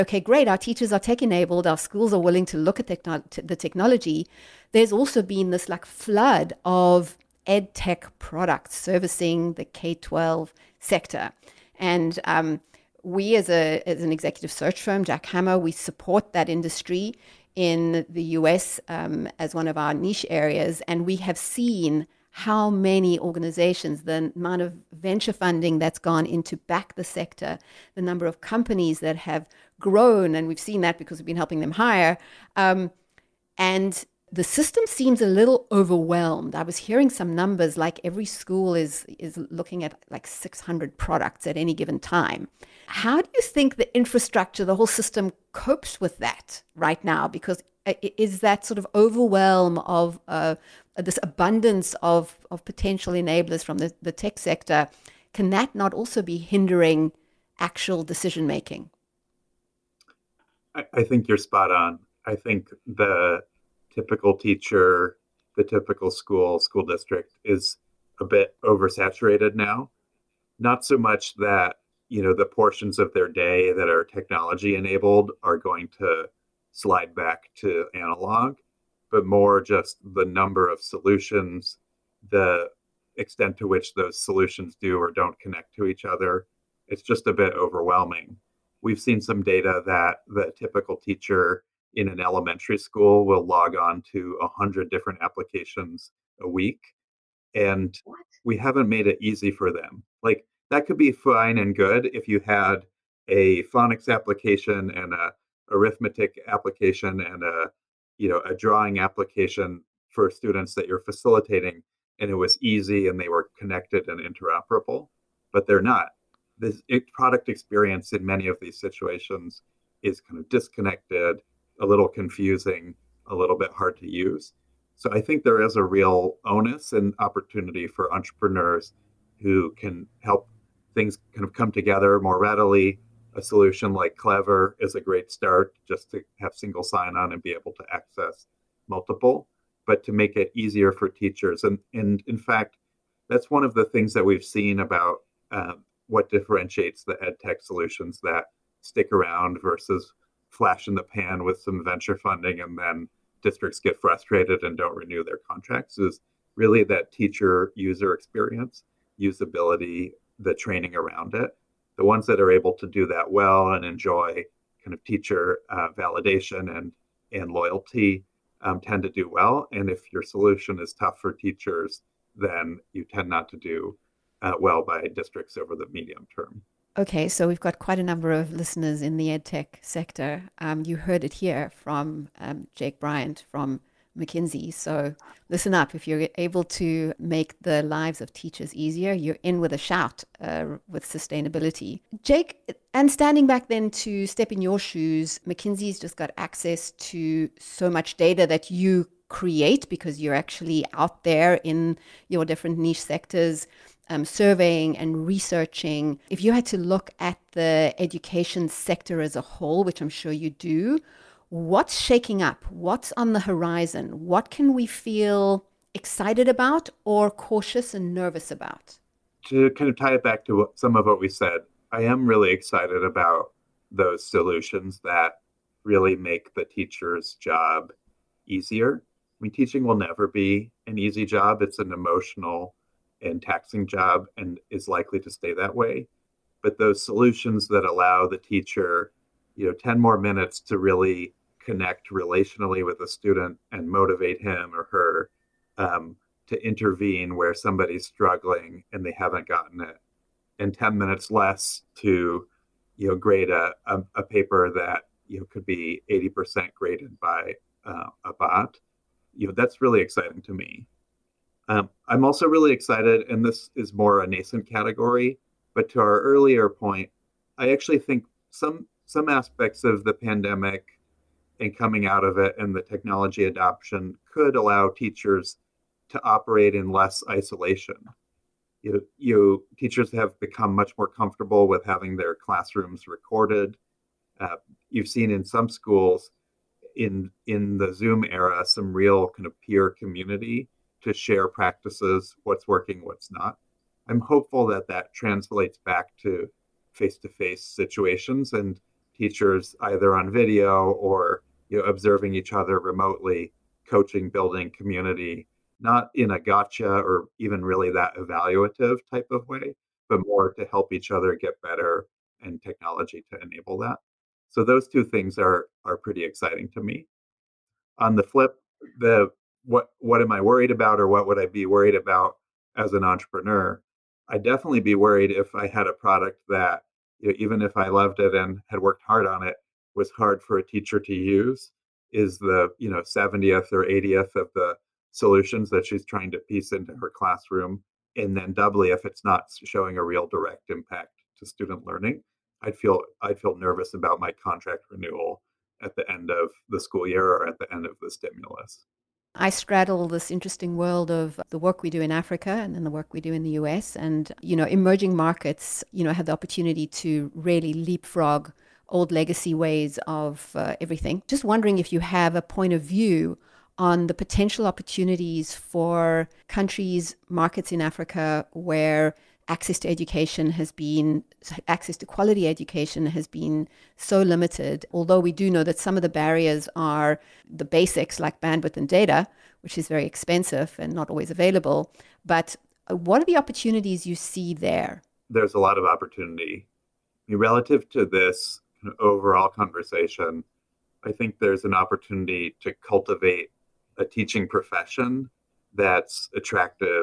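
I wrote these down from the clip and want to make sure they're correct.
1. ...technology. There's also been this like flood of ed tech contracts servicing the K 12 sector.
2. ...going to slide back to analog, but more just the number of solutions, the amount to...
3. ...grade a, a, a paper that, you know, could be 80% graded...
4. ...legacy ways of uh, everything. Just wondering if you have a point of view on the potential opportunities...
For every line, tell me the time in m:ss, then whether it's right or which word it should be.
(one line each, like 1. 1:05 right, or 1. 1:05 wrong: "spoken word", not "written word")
1. 0:03 wrong: "products", not "contracts"
2. 1:15 wrong: "extent", not "amount"
3. 4:13 right
4. 5:59 right.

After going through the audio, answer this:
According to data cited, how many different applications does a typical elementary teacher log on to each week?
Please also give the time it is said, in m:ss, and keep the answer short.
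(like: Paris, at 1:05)
100, at 1:34.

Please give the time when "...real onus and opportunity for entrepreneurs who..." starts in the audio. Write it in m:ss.
2:05.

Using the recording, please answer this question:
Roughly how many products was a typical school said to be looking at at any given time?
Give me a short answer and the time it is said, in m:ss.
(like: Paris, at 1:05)
600, at 0:40.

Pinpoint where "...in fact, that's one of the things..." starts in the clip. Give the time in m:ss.
2:22.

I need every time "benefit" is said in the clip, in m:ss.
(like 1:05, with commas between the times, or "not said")
not said.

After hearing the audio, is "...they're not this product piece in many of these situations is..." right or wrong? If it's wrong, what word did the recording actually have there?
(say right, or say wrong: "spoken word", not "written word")
wrong: "experience", not "piece".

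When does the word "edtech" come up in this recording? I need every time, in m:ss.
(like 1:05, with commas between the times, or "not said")
2:59.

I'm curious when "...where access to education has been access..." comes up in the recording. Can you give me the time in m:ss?
6:08.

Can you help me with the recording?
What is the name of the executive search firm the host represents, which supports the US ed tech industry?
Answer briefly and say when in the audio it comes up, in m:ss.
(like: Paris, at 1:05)
Jack Hammer, at 0:15.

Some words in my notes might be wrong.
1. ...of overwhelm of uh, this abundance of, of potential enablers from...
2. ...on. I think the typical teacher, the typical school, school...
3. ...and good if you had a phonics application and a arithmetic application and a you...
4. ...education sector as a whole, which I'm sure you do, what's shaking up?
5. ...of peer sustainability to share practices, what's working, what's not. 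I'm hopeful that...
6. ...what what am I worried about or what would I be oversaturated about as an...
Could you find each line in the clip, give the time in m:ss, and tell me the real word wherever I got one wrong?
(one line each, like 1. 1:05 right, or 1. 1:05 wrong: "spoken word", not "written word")
1. 0:48 right
2. 1:01 right
3. 1:41 right
4. 3:27 right
5. 4:49 wrong: "community", not "sustainability"
6. 5:19 wrong: "worried", not "oversaturated".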